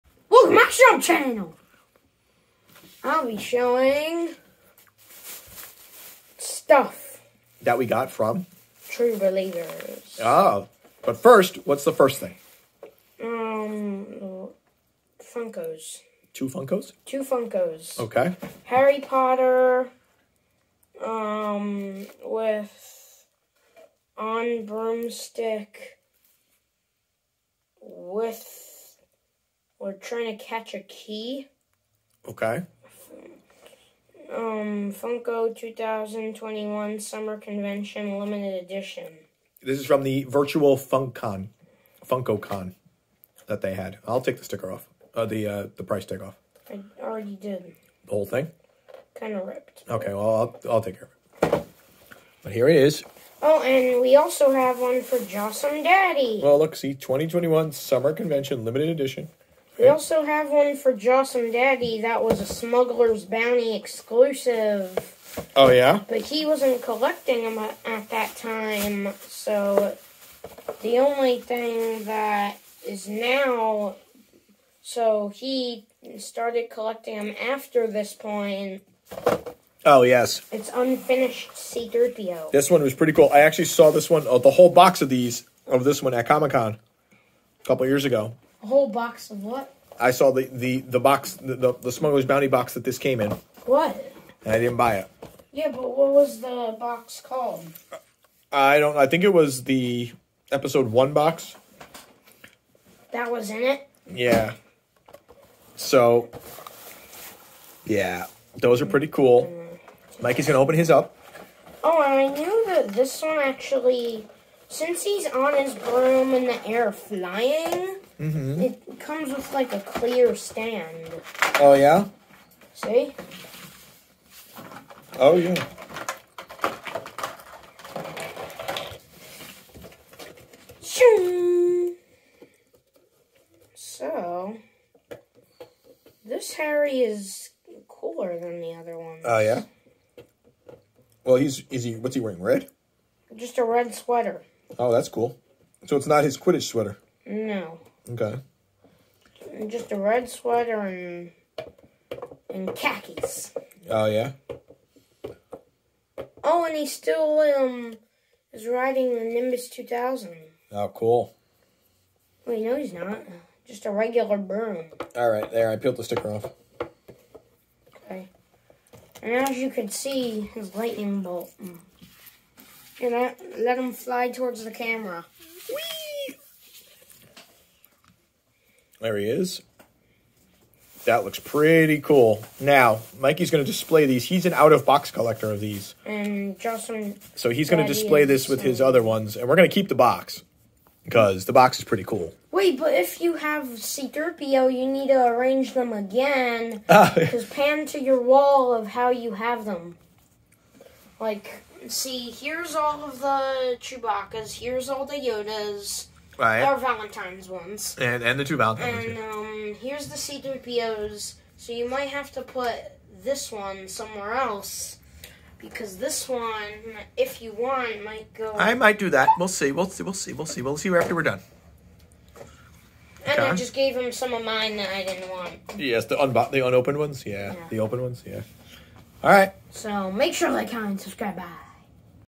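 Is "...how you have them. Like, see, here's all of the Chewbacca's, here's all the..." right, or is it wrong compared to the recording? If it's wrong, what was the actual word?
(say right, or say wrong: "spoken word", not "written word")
right.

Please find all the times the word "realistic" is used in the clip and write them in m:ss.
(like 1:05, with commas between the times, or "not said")
not said.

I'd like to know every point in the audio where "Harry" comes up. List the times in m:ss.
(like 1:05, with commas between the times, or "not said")
0:18, 2:16.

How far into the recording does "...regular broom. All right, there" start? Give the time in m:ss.
2:43.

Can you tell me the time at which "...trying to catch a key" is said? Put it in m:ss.
0:29.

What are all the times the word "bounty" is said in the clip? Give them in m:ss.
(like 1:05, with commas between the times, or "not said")
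1:03, 1:32.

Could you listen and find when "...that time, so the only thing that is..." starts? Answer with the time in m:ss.
1:08.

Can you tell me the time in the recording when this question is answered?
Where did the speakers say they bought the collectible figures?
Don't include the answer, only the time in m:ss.
0:08.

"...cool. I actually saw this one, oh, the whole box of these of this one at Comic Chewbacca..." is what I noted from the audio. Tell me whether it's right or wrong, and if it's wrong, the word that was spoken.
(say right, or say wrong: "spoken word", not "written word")
wrong: "Con", not "Chewbacca".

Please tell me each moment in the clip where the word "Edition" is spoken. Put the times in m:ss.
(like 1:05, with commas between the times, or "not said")
0:38, 0:58.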